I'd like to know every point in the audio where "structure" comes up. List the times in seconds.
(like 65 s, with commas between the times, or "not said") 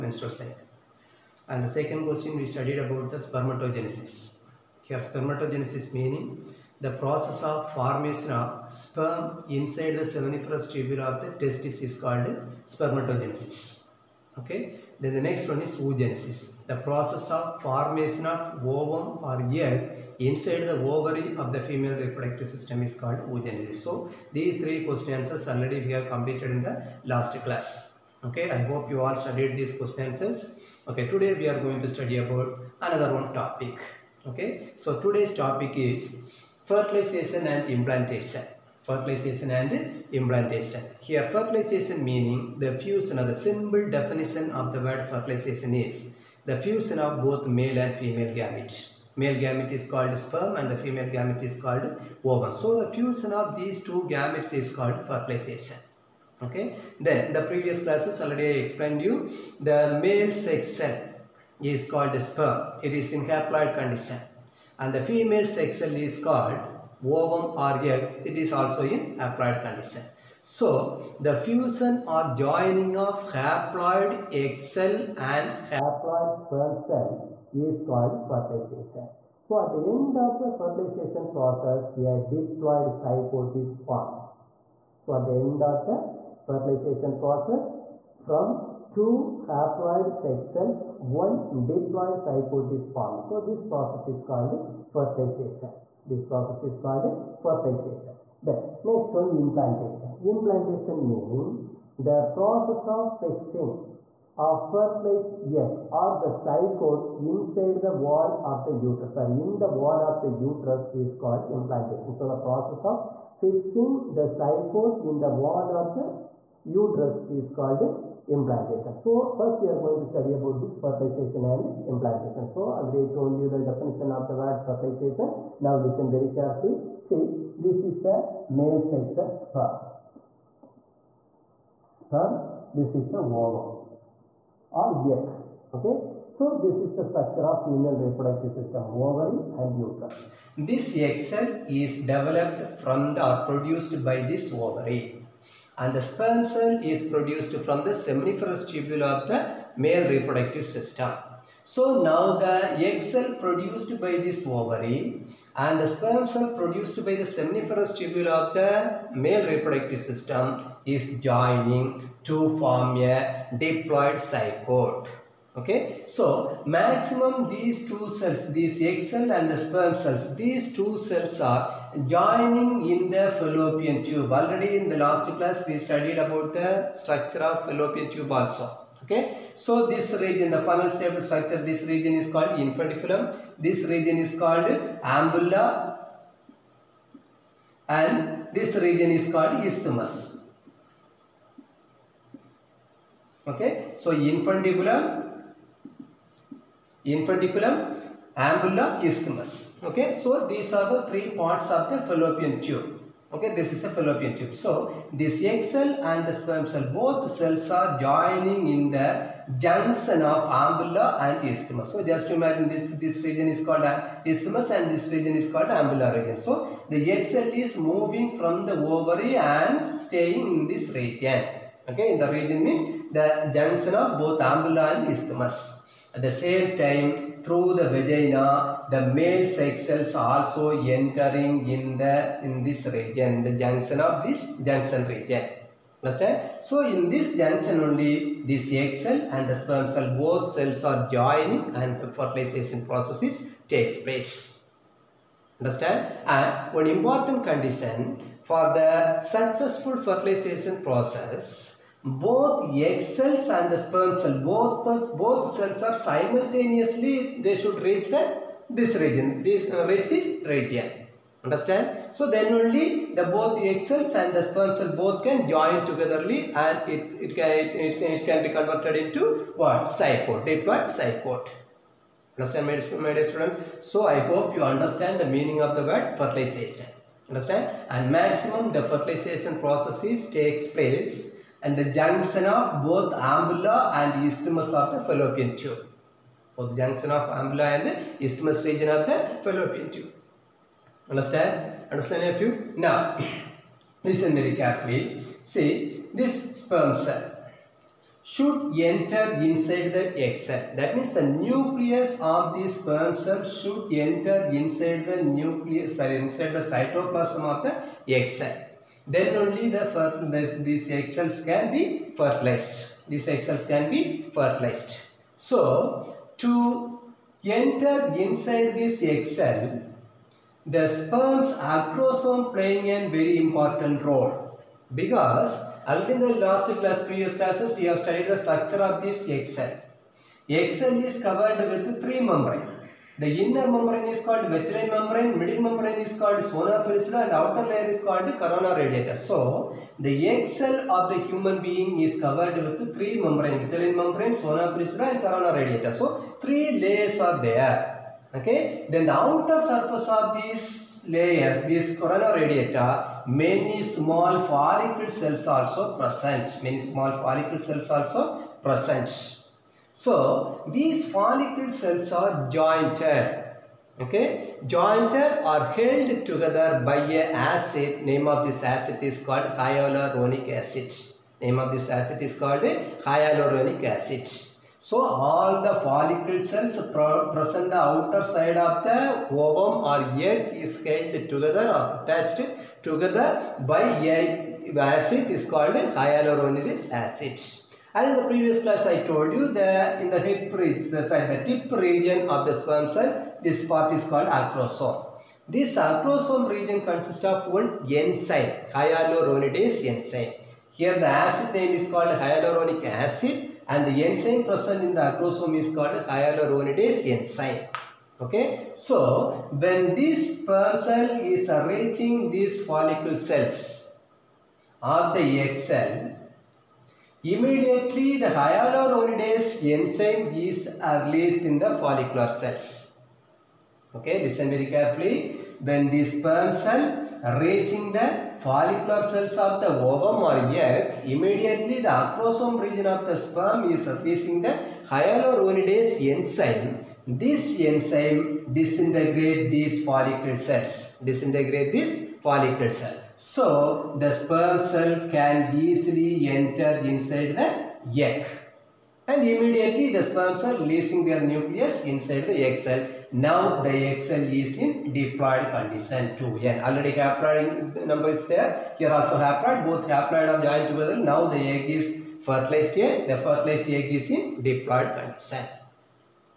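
137 s, 176 s, 181 s, 328 s.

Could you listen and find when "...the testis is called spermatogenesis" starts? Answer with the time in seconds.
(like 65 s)
11 s.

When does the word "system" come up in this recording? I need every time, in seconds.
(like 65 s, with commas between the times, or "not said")
22 s, 138 s, 150 s, 159 s.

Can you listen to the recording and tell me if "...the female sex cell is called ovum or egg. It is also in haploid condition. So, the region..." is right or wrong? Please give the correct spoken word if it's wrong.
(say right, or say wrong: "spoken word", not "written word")
wrong: "fusion", not "region".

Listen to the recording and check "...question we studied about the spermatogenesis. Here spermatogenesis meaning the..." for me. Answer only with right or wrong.
right.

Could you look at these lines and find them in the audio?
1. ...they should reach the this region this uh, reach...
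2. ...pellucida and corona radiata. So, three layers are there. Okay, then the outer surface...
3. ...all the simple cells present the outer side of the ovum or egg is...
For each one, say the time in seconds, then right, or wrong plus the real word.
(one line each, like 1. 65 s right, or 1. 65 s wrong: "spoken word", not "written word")
1. 257 s right
2. 344 s right
3. 375 s wrong: "follicle", not "simple".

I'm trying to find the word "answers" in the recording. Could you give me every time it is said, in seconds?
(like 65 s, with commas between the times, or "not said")
25 s, 30 s.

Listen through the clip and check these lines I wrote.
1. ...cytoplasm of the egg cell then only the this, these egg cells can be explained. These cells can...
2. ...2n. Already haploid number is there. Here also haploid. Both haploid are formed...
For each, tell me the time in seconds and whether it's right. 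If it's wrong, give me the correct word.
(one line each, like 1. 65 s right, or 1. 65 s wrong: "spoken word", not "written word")
1. 306 s wrong: "fertilized", not "explained"
2. 456 s wrong: "joined", not "formed".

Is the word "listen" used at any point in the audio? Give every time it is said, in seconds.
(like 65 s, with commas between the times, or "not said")
125 s, 294 s, 424 s.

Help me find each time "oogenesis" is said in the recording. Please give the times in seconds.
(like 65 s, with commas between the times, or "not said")
15 s, 23 s.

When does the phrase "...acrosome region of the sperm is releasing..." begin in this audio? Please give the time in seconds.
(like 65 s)
431 s.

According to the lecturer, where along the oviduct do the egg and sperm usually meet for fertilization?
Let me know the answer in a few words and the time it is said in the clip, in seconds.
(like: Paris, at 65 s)
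Junction of ampulla and isthmus, at 209 s.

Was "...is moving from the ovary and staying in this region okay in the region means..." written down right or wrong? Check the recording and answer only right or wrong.
right.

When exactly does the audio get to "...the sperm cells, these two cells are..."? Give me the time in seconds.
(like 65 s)
169 s.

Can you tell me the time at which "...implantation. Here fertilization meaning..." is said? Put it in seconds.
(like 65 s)
40 s.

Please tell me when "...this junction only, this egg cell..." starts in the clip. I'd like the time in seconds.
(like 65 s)
237 s.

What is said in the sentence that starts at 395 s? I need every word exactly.
This acrosome region consists of one enzyme, hyaluronidase enzyme.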